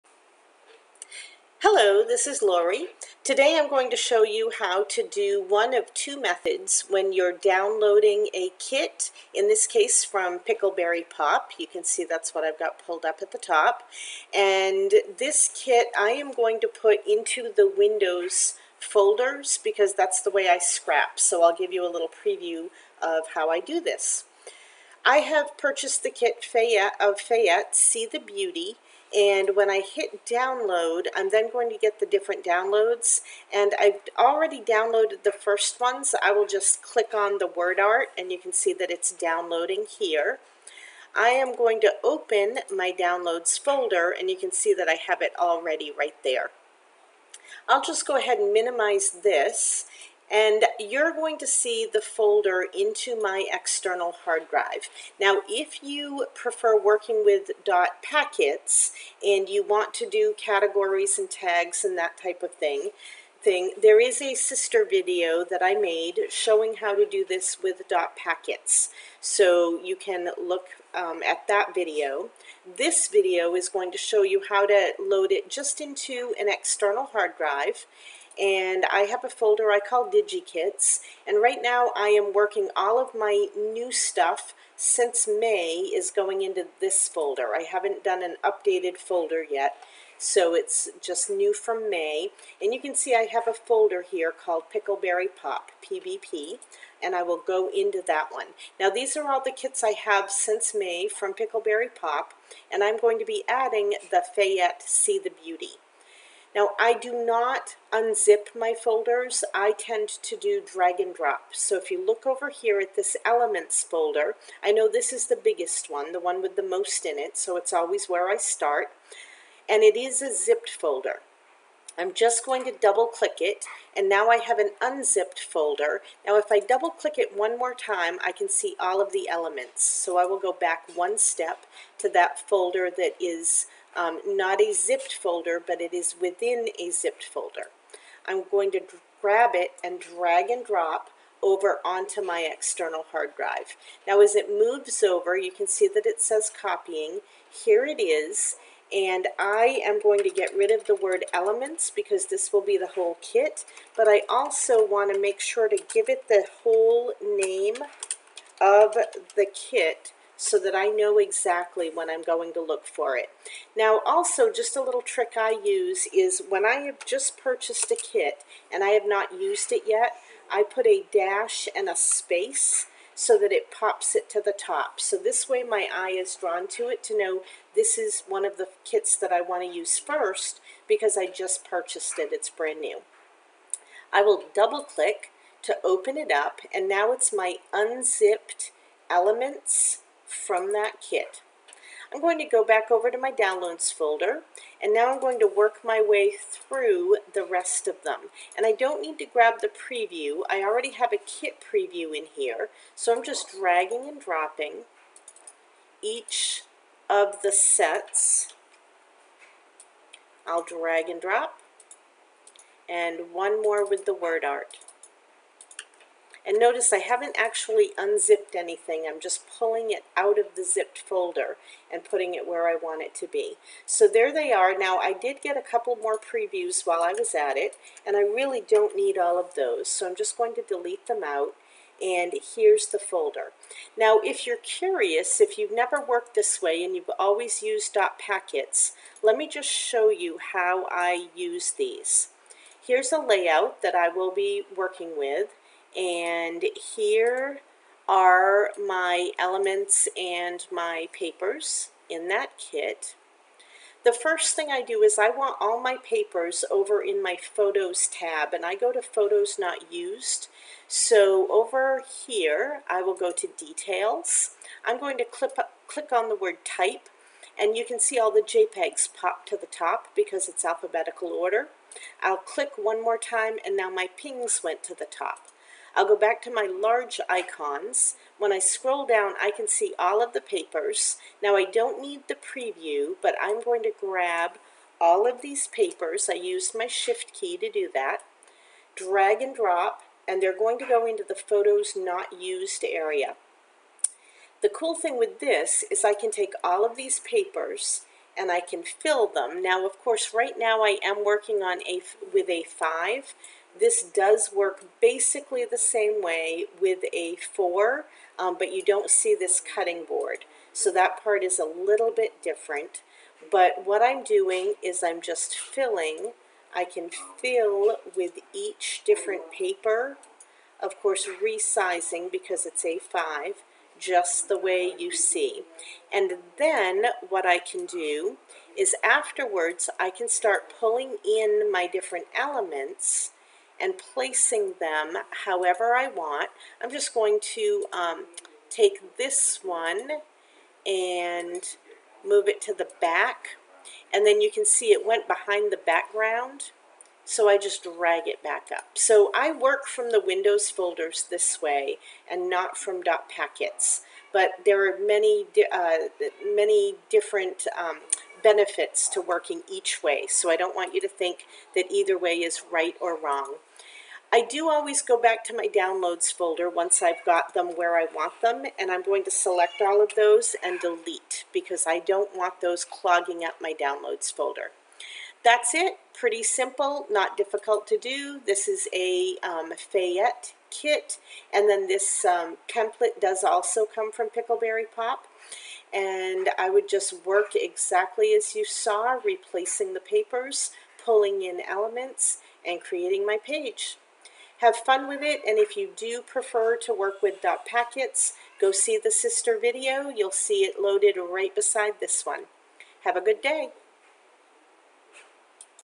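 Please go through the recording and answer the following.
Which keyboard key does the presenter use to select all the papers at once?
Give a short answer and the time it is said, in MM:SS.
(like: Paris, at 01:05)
shift key, at 04:46.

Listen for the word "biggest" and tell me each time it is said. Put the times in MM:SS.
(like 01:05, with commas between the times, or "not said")
01:55.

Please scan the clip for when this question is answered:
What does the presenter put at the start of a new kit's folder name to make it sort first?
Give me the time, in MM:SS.
02:50.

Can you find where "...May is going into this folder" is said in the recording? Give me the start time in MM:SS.
01:25.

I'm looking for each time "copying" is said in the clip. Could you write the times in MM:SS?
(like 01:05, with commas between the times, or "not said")
02:26.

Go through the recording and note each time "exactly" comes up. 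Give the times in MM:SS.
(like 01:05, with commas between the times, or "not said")
02:41, 06:27.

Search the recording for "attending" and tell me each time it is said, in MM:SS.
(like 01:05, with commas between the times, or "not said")
not said.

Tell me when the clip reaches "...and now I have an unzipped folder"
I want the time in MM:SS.
02:03.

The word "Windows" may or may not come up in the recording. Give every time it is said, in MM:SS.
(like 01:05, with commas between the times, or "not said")
00:17, 05:50.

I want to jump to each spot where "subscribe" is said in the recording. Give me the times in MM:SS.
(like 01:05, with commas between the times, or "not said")
not said.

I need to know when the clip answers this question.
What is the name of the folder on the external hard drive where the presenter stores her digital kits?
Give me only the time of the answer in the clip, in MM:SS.
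01:20.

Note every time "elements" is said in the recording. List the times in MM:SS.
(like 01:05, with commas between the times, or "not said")
01:53, 02:09, 02:31, 03:09, 04:09, 05:32, 06:31.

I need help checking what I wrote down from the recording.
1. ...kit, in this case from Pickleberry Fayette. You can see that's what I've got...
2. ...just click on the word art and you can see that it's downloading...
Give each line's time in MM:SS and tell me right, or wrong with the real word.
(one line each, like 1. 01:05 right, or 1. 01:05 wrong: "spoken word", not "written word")
1. 00:08 wrong: "Pop", not "Fayette"
2. 00:36 right.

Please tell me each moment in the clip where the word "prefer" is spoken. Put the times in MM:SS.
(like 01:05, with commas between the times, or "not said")
00:56, 06:36.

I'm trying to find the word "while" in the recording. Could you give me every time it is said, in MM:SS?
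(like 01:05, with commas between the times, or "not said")
03:46.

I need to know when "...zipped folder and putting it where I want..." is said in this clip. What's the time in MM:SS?
03:40.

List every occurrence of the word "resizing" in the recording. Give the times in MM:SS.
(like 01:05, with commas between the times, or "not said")
05:21.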